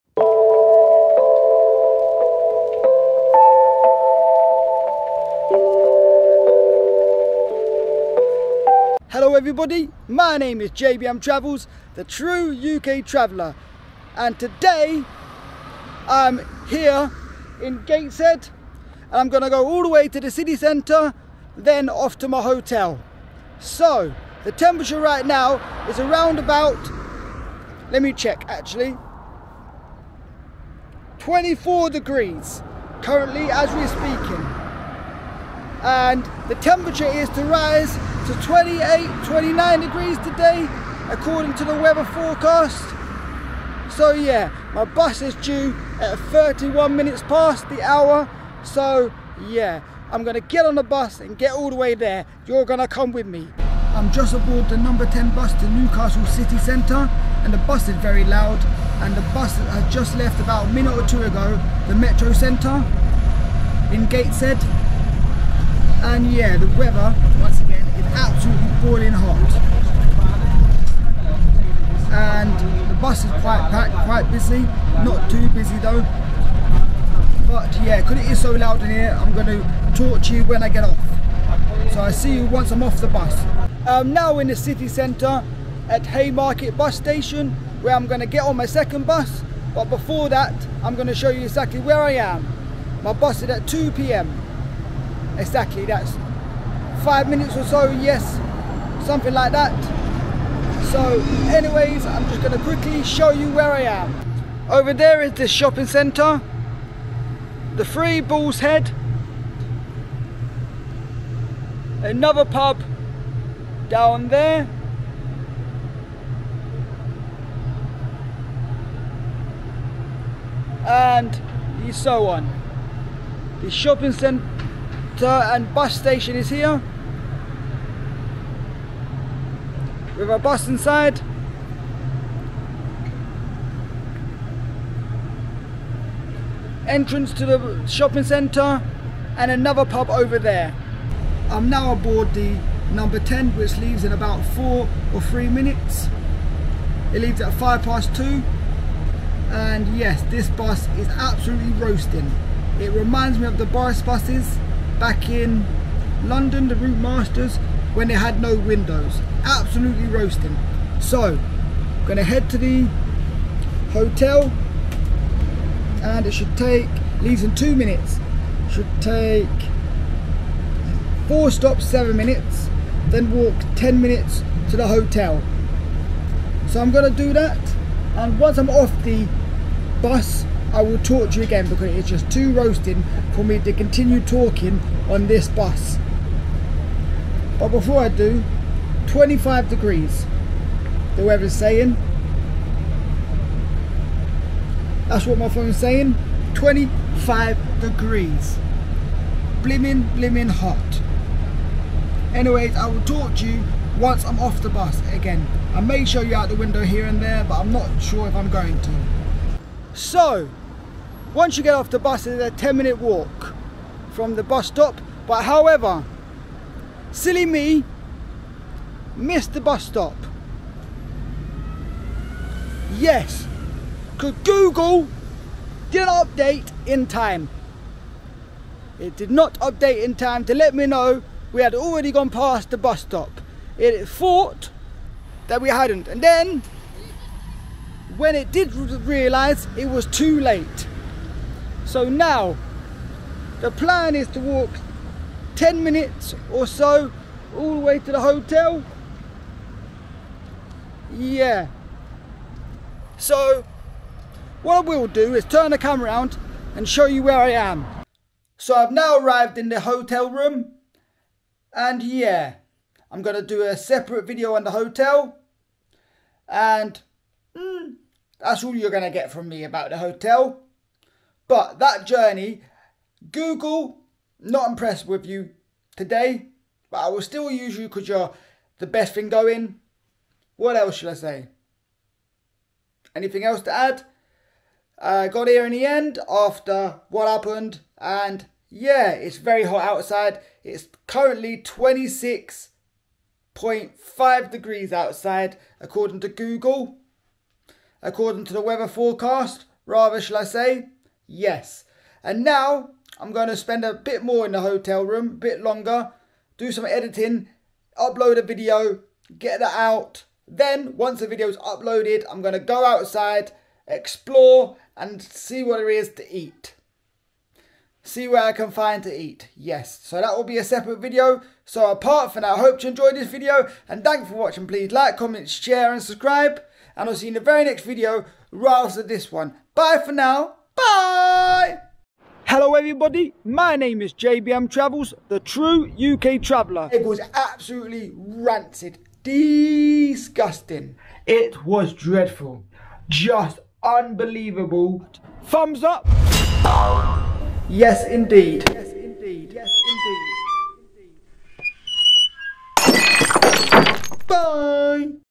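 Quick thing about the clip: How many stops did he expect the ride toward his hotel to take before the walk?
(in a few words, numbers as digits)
4.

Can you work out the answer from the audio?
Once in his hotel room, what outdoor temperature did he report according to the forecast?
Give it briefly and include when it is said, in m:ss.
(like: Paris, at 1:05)
26.5 degrees, at 4:51.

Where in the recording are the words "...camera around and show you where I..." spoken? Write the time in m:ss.
4:15.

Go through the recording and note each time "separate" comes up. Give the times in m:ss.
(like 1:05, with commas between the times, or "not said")
4:23, 5:20.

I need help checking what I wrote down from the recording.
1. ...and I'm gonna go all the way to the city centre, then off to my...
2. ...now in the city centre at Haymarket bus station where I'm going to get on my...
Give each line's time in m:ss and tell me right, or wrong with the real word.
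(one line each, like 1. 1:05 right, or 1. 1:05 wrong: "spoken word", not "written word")
1. 0:19 right
2. 1:24 right.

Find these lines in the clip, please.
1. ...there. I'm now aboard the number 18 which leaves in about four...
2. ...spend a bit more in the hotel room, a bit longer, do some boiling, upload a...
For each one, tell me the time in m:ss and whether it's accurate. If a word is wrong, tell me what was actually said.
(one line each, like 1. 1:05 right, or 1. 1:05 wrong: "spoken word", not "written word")
1. 2:20 wrong: "10", not "18"
2. 5:03 wrong: "editing", not "boiling".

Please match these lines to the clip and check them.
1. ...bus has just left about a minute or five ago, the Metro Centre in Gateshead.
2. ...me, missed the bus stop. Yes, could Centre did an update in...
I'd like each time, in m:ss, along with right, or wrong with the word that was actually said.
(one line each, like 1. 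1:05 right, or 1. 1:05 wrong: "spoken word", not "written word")
1. 0:59 wrong: "two", not "five"
2. 3:37 wrong: "Google", not "Centre".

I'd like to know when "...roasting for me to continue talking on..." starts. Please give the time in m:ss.
3:02.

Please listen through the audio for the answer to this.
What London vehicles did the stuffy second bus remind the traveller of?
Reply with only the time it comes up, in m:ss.
2:33.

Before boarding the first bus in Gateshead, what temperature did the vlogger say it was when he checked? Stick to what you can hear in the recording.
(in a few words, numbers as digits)
24 degrees.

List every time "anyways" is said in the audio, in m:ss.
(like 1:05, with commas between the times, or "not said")
1:41, 3:22.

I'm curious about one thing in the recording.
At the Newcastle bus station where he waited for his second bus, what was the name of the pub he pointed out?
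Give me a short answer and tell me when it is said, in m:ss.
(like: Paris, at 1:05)
Three Bulls Head, at 1:47.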